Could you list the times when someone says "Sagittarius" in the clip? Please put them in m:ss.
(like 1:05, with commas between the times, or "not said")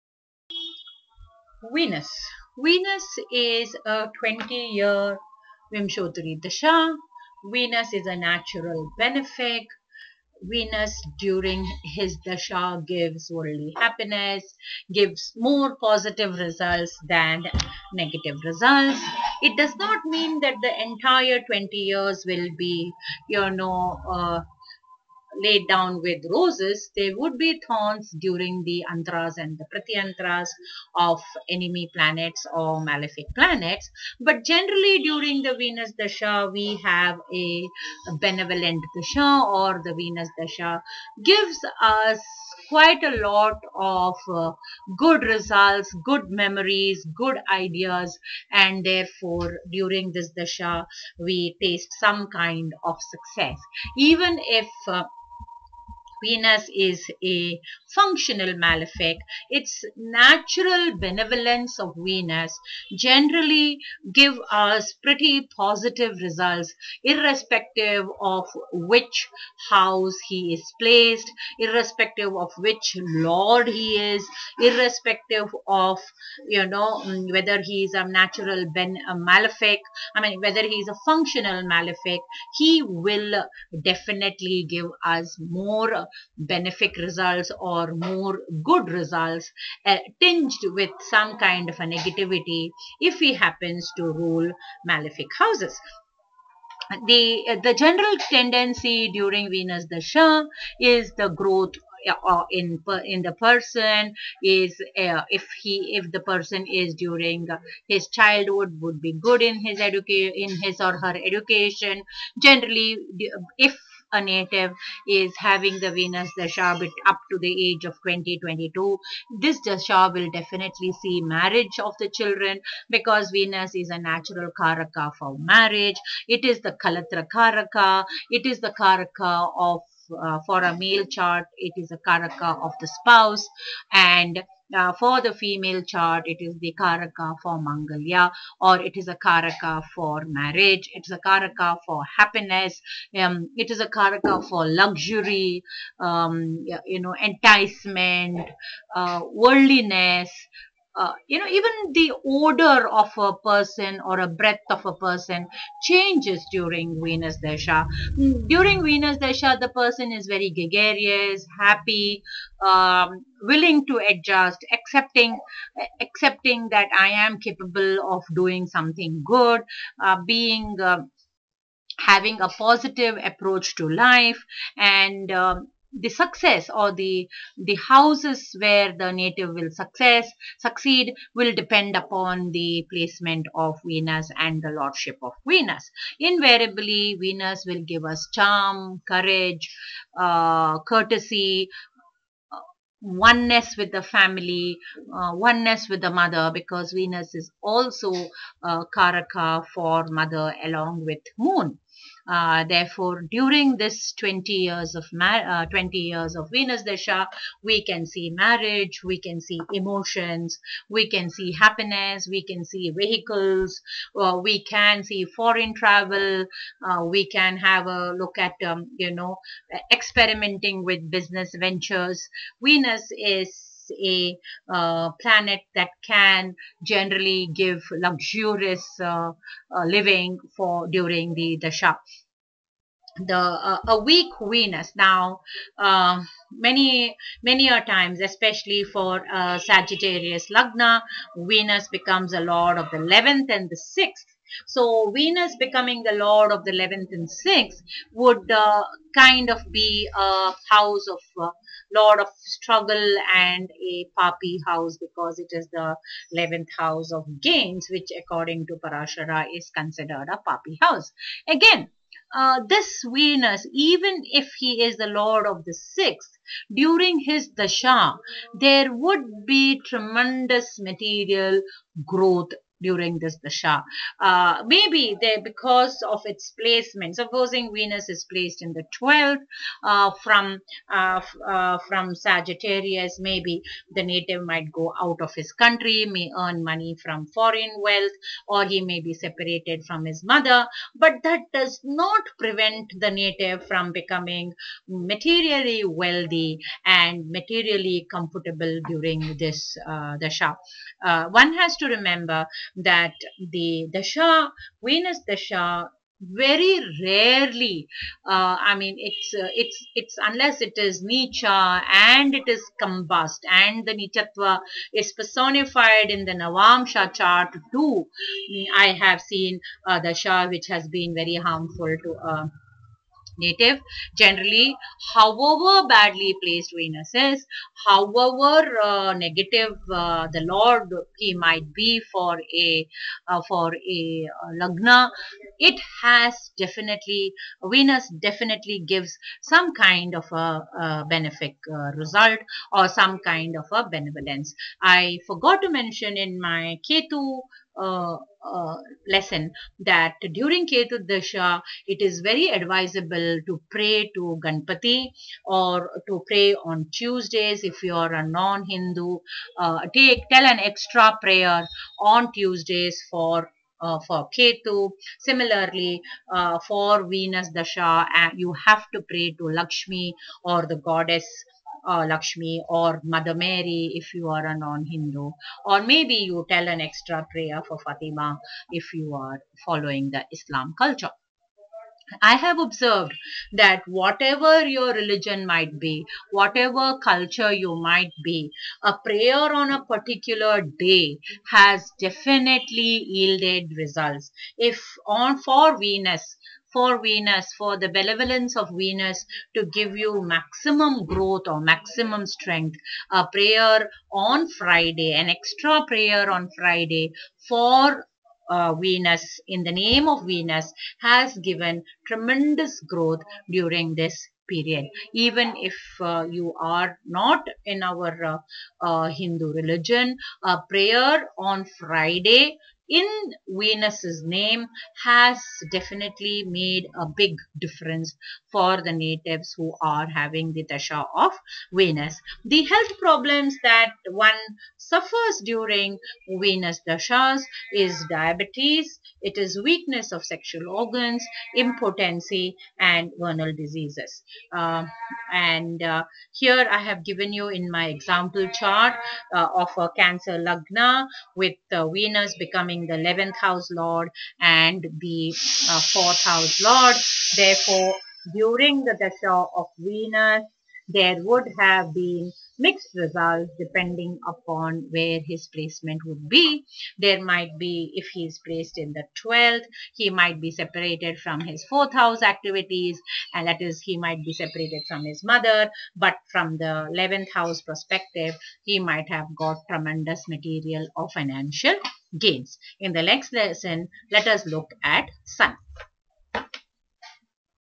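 3:59, 4:42.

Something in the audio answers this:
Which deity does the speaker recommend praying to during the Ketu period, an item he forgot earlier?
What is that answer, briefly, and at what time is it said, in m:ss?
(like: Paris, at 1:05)
Ganpati, at 5:54.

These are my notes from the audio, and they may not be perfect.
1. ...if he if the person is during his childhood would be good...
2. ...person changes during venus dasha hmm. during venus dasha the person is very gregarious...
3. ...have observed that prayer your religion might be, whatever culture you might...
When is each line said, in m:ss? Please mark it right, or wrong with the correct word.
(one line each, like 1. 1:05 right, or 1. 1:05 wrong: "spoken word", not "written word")
1. 1:45 right
2. 2:34 right
3. 6:22 wrong: "whatever", not "prayer".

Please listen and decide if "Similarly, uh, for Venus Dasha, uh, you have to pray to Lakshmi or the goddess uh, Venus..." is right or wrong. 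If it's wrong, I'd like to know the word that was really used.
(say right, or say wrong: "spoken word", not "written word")
wrong: "Lakshmi", not "Venus".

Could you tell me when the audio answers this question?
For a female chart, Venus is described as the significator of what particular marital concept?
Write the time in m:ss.
2:17.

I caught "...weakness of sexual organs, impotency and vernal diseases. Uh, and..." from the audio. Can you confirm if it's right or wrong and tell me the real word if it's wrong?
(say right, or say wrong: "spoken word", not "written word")
right.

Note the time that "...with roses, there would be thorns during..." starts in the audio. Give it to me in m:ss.
0:26.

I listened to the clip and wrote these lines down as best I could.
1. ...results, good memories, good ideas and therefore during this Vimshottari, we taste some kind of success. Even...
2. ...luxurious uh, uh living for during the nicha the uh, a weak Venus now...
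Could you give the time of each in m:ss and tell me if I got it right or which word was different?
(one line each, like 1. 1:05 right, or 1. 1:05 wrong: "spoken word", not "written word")
1. 0:45 wrong: "Dasha", not "Vimshottari"
2. 3:47 wrong: "dasha", not "nicha".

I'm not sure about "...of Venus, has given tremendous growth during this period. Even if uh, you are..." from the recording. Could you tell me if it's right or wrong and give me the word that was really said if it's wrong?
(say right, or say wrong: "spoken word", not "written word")
right.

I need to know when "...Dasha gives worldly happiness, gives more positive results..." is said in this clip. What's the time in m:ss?
0:12.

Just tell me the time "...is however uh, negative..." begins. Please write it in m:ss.
5:27.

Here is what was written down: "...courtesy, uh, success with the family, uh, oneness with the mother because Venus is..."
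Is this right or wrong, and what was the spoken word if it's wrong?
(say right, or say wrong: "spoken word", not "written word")
wrong: "oneness", not "success".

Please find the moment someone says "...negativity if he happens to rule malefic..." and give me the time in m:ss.
1:31.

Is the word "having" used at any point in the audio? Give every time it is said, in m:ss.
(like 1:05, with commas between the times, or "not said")
1:55, 2:52, 7:10.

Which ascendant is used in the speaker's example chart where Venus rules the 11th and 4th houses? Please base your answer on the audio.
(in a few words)
Cancer.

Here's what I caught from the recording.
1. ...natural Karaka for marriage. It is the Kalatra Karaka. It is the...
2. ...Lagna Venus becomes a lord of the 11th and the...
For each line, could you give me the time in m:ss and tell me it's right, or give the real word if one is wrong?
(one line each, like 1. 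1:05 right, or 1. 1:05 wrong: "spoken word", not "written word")
1. 2:03 right
2. 4:00 right.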